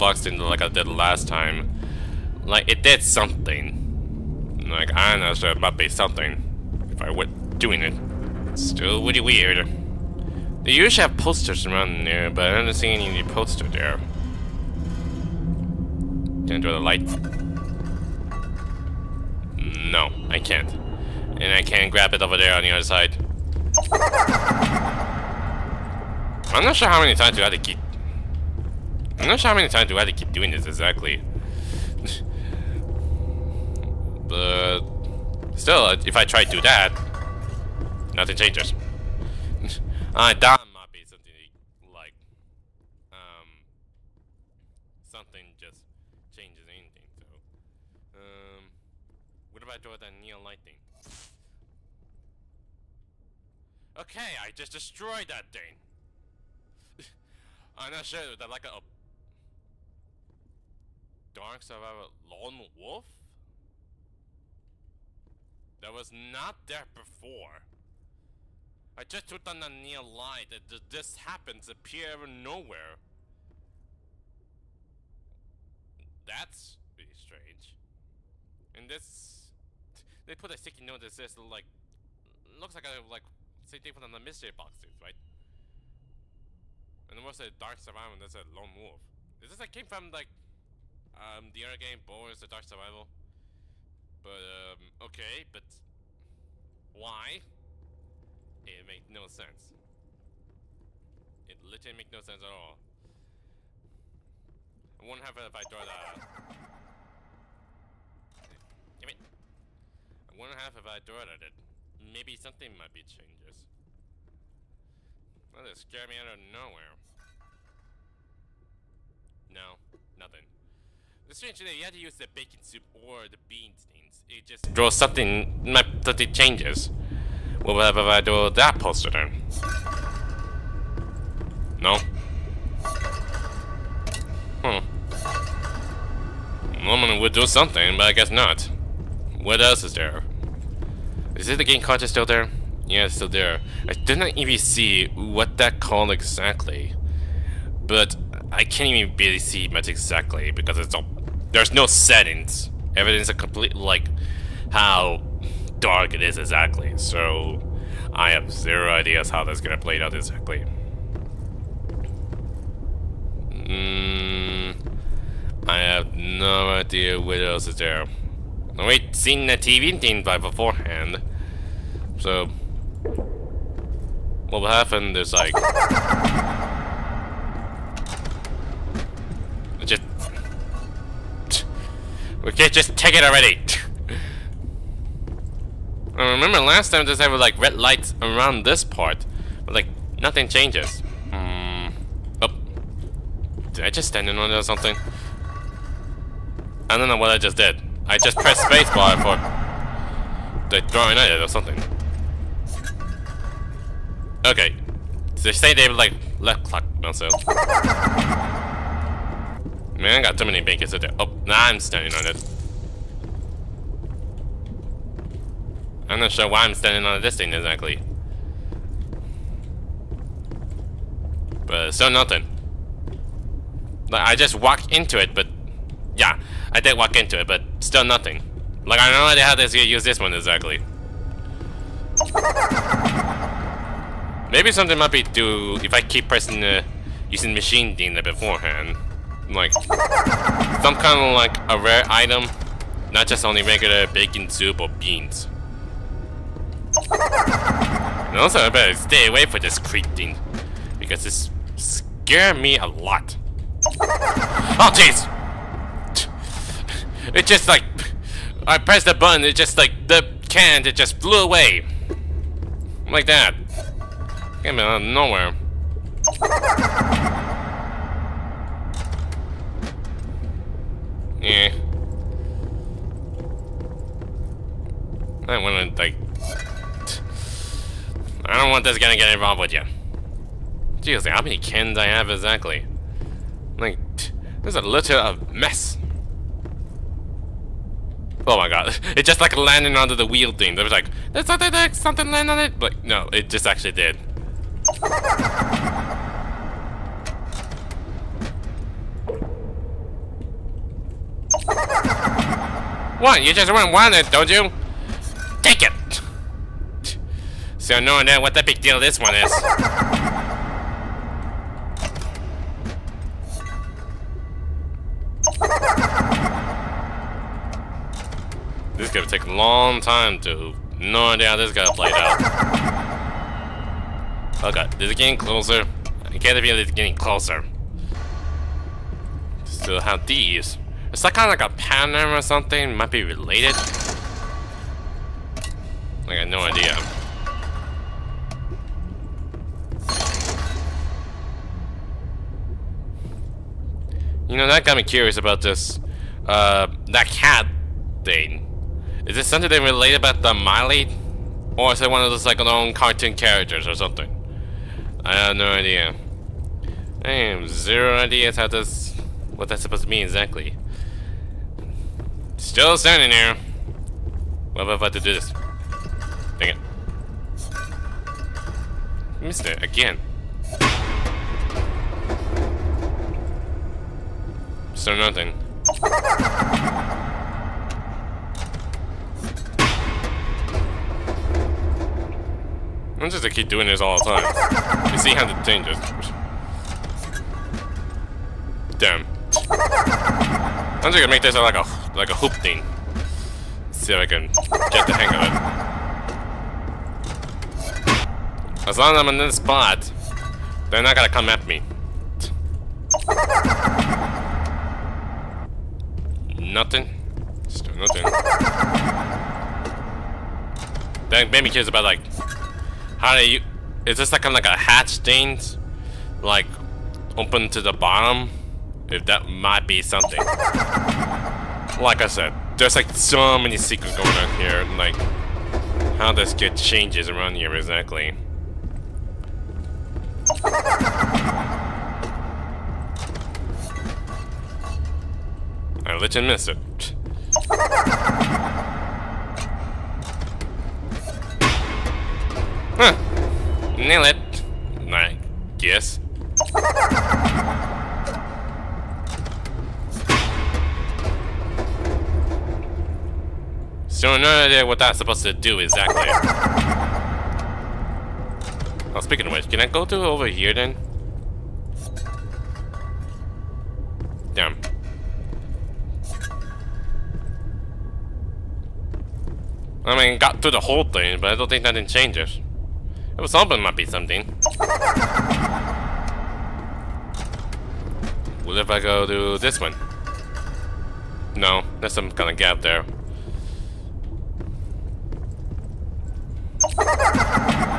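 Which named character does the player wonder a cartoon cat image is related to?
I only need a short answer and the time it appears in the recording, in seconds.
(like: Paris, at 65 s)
Miley, at 350 s.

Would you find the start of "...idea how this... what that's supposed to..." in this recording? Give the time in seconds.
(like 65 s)
358 s.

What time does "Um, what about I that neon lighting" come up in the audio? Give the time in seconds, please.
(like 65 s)
48 s.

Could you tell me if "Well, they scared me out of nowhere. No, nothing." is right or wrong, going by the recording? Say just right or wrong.
right.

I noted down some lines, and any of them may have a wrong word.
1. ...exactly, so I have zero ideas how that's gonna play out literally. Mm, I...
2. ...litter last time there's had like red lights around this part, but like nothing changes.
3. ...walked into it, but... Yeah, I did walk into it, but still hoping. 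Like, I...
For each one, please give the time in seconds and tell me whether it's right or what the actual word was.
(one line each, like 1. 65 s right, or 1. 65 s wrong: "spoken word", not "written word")
1. 156 s wrong: "exactly", not "literally"
2. 186 s wrong: "remember", not "litter"
3. 224 s wrong: "nothing", not "hoping".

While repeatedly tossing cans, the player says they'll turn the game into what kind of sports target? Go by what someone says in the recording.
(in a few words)
a hoop.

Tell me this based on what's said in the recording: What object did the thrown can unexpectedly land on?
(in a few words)
the wheel thing.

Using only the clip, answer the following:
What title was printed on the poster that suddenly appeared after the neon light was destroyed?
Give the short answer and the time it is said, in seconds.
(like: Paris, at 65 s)
Dark Survivor Lone Wolf, at 61 s.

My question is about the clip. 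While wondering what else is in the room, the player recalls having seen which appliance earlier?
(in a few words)
TV.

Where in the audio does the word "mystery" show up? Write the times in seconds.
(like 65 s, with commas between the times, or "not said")
84 s.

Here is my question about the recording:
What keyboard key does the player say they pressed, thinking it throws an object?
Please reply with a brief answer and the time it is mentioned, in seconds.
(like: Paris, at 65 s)
spacebar, at 198 s.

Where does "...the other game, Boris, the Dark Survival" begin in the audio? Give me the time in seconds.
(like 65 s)
91 s.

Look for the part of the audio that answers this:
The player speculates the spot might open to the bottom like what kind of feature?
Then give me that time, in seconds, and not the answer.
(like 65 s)
414 s.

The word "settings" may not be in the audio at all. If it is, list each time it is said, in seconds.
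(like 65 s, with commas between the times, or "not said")
151 s.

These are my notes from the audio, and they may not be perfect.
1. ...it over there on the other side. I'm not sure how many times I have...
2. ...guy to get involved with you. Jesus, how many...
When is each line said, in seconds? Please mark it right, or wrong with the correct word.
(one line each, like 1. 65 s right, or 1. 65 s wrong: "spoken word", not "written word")
1. 22 s right
2. 278 s right.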